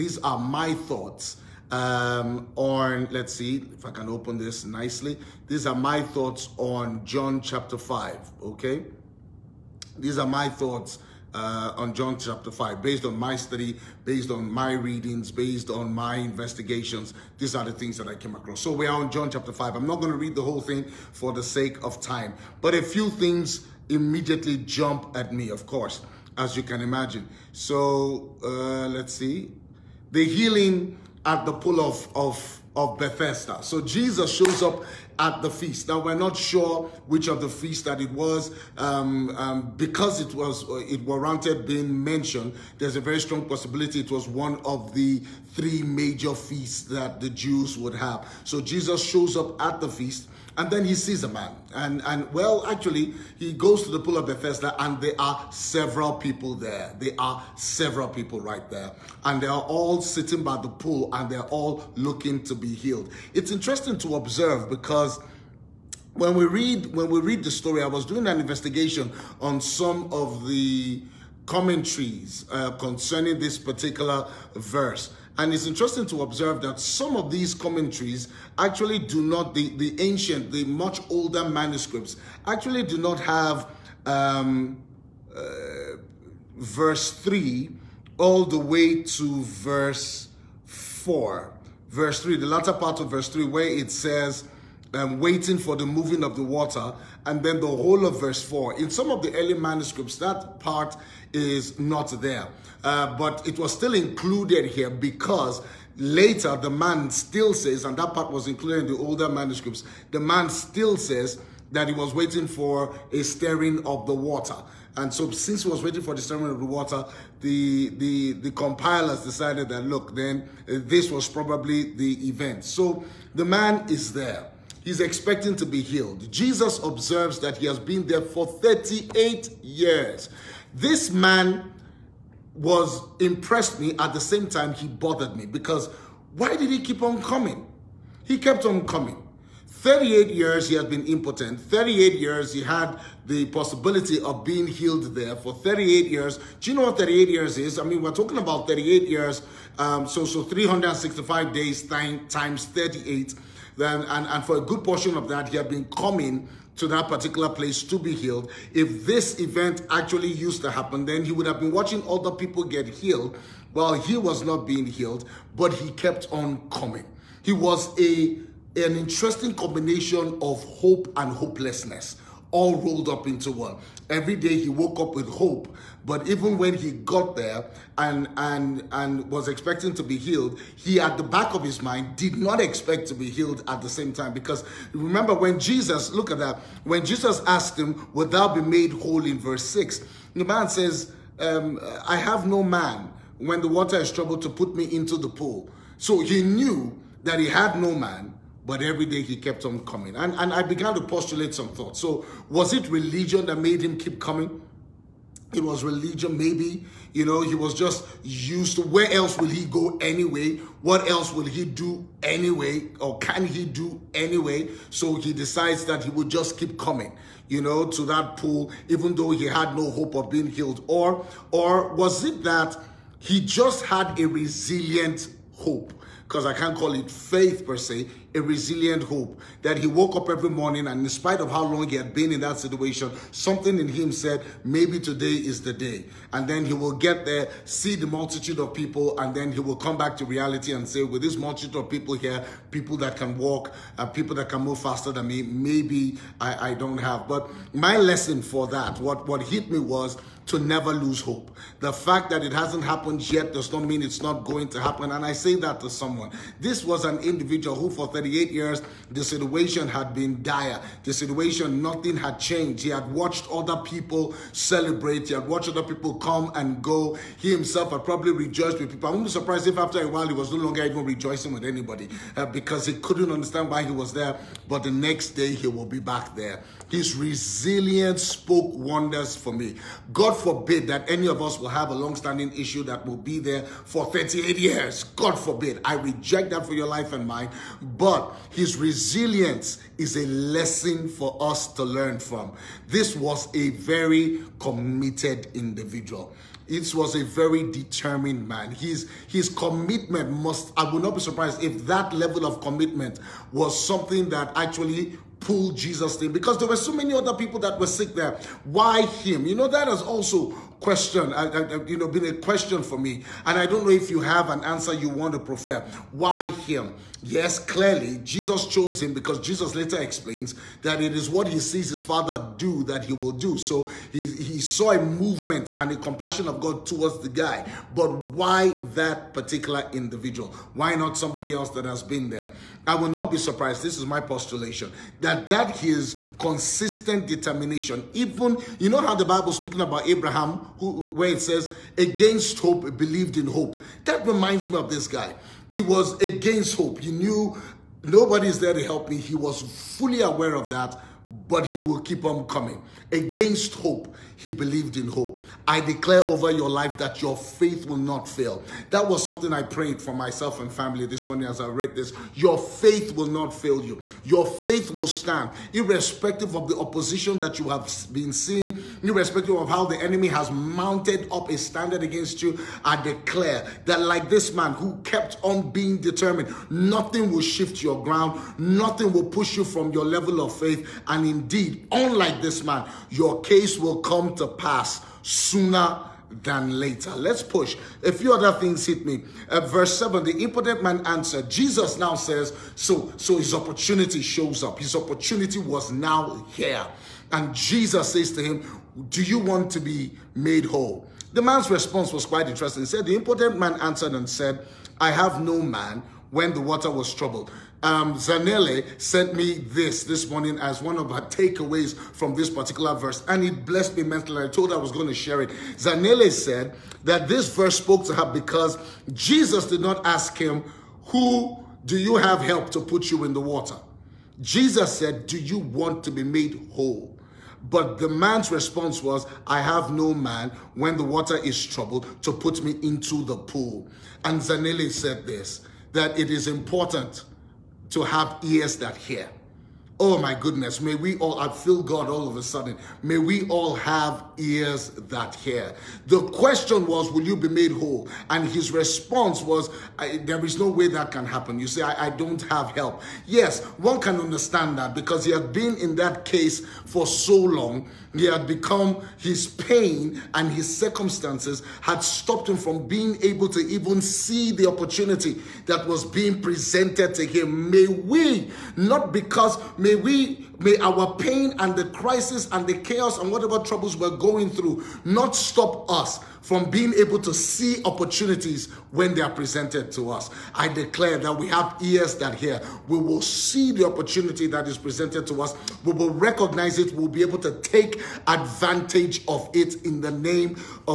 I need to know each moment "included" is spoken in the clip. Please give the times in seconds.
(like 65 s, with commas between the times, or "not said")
103 s, 108 s.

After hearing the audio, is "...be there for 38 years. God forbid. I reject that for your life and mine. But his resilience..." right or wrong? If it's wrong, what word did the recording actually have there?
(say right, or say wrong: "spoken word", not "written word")
right.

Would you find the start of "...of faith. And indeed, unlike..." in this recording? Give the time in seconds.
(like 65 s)
380 s.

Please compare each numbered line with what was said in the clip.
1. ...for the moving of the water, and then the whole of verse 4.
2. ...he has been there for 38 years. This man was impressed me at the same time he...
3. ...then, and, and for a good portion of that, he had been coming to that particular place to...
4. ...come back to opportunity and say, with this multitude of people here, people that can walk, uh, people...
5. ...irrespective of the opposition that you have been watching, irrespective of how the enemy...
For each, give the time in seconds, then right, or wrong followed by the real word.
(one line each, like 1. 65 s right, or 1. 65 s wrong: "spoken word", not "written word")
1. 95 s right
2. 127 s right
3. 153 s right
4. 239 s wrong: "reality", not "opportunity"
5. 365 s wrong: "seeing", not "watching".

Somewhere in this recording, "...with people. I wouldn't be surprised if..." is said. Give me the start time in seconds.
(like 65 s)
268 s.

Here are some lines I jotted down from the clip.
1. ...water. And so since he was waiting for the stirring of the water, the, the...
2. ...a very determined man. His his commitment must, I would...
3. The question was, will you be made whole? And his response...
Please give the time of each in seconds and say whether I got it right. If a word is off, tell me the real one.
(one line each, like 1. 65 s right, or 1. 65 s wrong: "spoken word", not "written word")
1. 114 s right
2. 297 s right
3. 446 s right.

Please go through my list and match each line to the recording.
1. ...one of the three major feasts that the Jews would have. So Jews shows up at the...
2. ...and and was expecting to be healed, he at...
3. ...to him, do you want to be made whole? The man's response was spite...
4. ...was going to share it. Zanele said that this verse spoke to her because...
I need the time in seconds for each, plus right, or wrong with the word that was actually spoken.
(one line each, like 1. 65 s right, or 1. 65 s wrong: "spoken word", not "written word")
1. 44 s wrong: "Jesus", not "Jews"
2. 178 s right
3. 398 s wrong: "quite", not "spite"
4. 414 s right.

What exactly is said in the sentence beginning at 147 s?
I mean, we're talking about 38 years.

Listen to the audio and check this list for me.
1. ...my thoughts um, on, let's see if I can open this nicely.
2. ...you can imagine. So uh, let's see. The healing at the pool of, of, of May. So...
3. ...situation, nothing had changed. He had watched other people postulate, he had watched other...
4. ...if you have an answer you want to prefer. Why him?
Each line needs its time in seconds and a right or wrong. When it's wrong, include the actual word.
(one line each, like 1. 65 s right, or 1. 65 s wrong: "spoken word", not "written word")
1. 0 s right
2. 26 s wrong: "Bethesda", not "May"
3. 261 s wrong: "celebrate", not "postulate"
4. 313 s right.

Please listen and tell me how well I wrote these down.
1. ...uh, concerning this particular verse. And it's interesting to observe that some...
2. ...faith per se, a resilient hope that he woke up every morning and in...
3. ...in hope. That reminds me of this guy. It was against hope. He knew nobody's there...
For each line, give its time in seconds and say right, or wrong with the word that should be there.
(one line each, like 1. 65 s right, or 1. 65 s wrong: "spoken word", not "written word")
1. 72 s right
2. 227 s right
3. 343 s right.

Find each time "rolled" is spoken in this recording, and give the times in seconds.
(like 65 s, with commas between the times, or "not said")
172 s.